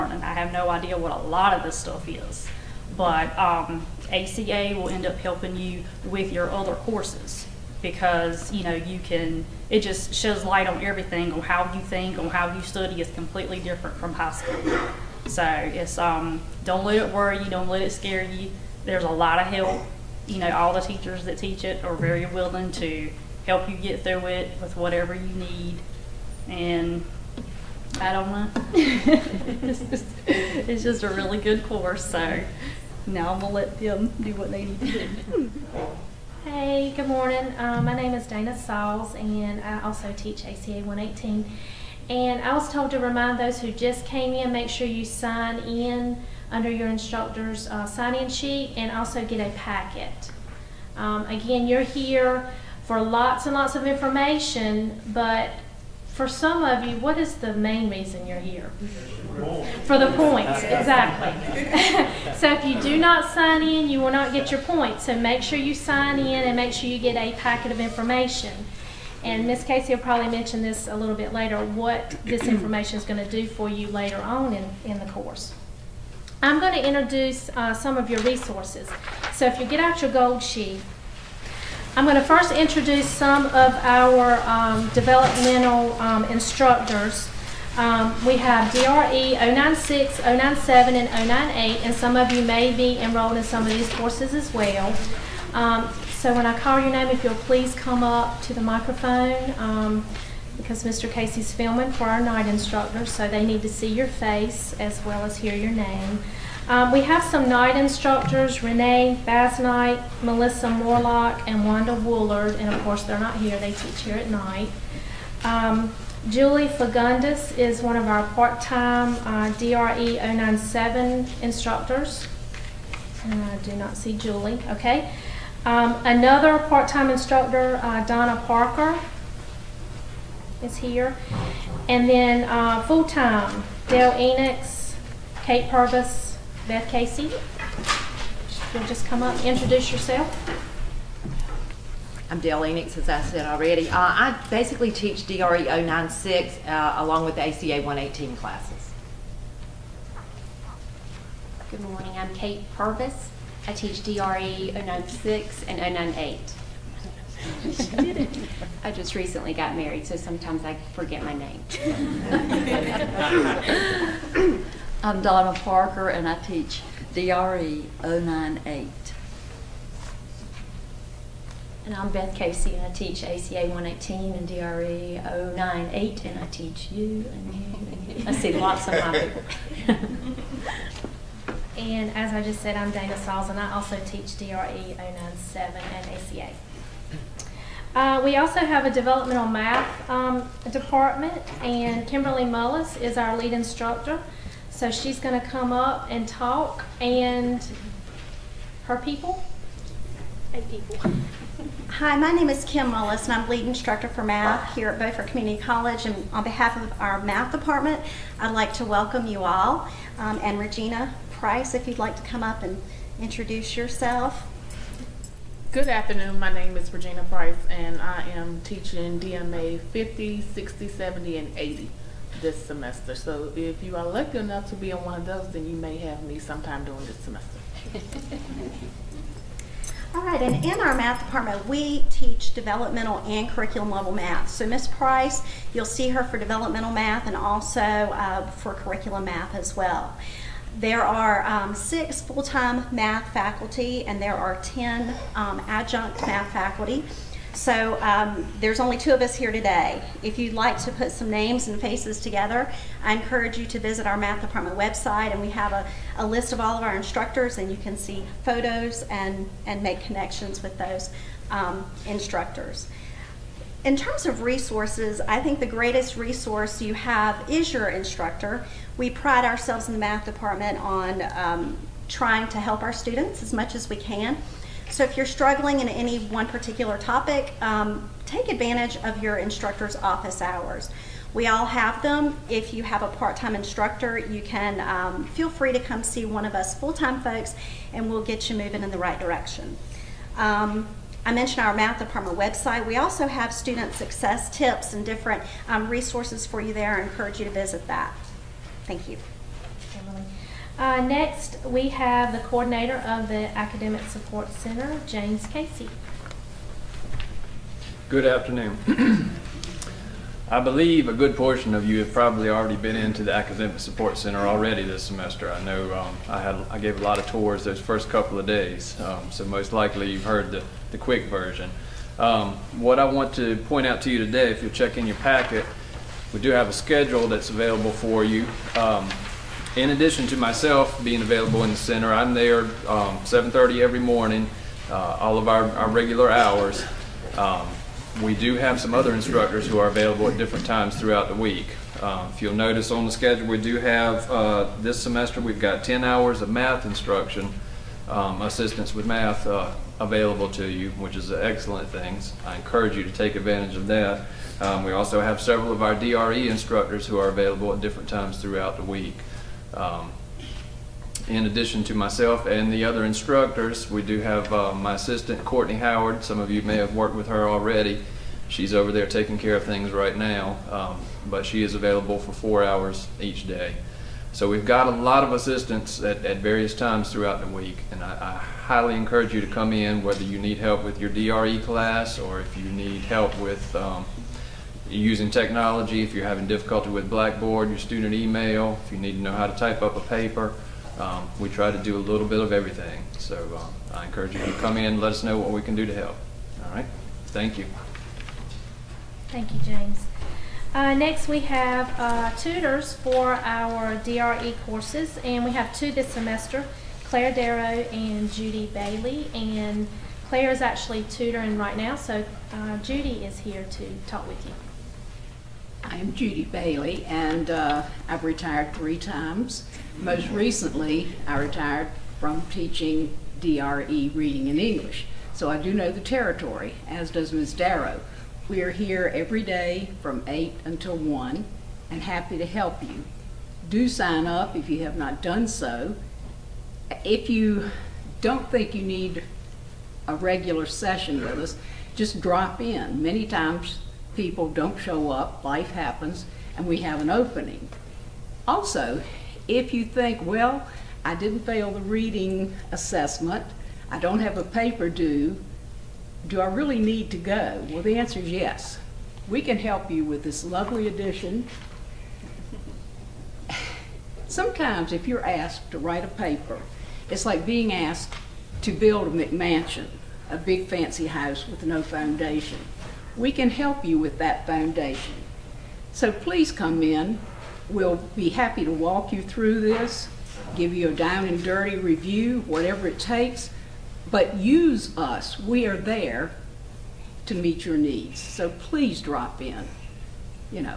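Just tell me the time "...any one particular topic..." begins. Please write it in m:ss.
4:35.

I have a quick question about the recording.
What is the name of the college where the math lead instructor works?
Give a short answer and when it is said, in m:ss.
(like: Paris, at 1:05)
Beaufort Community College, at 3:24.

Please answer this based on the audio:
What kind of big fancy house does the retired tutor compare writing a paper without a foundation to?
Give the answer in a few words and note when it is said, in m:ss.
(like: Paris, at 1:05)
McMansion, at 7:49.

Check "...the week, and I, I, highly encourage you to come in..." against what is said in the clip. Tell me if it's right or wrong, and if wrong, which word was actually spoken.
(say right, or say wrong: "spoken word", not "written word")
right.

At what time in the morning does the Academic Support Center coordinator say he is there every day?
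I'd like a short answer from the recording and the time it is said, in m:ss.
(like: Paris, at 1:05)
7:30, at 5:33.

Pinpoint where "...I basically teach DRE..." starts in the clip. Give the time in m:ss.
2:23.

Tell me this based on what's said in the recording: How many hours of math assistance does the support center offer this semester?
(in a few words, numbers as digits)
10 hours.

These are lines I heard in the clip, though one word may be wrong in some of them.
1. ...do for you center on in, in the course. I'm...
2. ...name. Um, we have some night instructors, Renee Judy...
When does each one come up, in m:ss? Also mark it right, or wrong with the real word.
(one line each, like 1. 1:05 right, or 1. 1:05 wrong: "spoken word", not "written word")
1. 1:13 wrong: "later", not "center"
2. 1:45 wrong: "Basnight", not "Judy".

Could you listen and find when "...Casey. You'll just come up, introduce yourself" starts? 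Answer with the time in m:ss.
2:16.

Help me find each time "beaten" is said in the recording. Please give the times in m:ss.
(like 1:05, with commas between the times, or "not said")
not said.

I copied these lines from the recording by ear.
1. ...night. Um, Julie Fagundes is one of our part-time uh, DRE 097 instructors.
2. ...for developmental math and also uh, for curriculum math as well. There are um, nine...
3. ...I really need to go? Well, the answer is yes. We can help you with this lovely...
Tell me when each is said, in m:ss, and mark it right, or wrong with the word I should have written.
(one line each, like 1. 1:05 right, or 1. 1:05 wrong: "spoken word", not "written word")
1. 1:54 right
2. 3:56 wrong: "six", not "nine"
3. 7:36 right.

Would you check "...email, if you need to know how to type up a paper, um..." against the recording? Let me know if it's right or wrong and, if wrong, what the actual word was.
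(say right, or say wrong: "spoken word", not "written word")
right.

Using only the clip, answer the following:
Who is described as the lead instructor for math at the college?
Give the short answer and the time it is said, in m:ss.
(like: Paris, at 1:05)
Kim Mullis, at 3:22.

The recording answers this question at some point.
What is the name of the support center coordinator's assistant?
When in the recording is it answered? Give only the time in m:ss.
6:05.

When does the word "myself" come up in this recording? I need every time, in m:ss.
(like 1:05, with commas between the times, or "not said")
5:30, 6:01.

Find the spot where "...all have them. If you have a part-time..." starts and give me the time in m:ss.
4:41.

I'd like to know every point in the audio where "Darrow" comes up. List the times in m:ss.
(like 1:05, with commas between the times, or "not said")
6:47, 7:07.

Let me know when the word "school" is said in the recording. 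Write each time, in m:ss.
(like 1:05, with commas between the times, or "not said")
0:14.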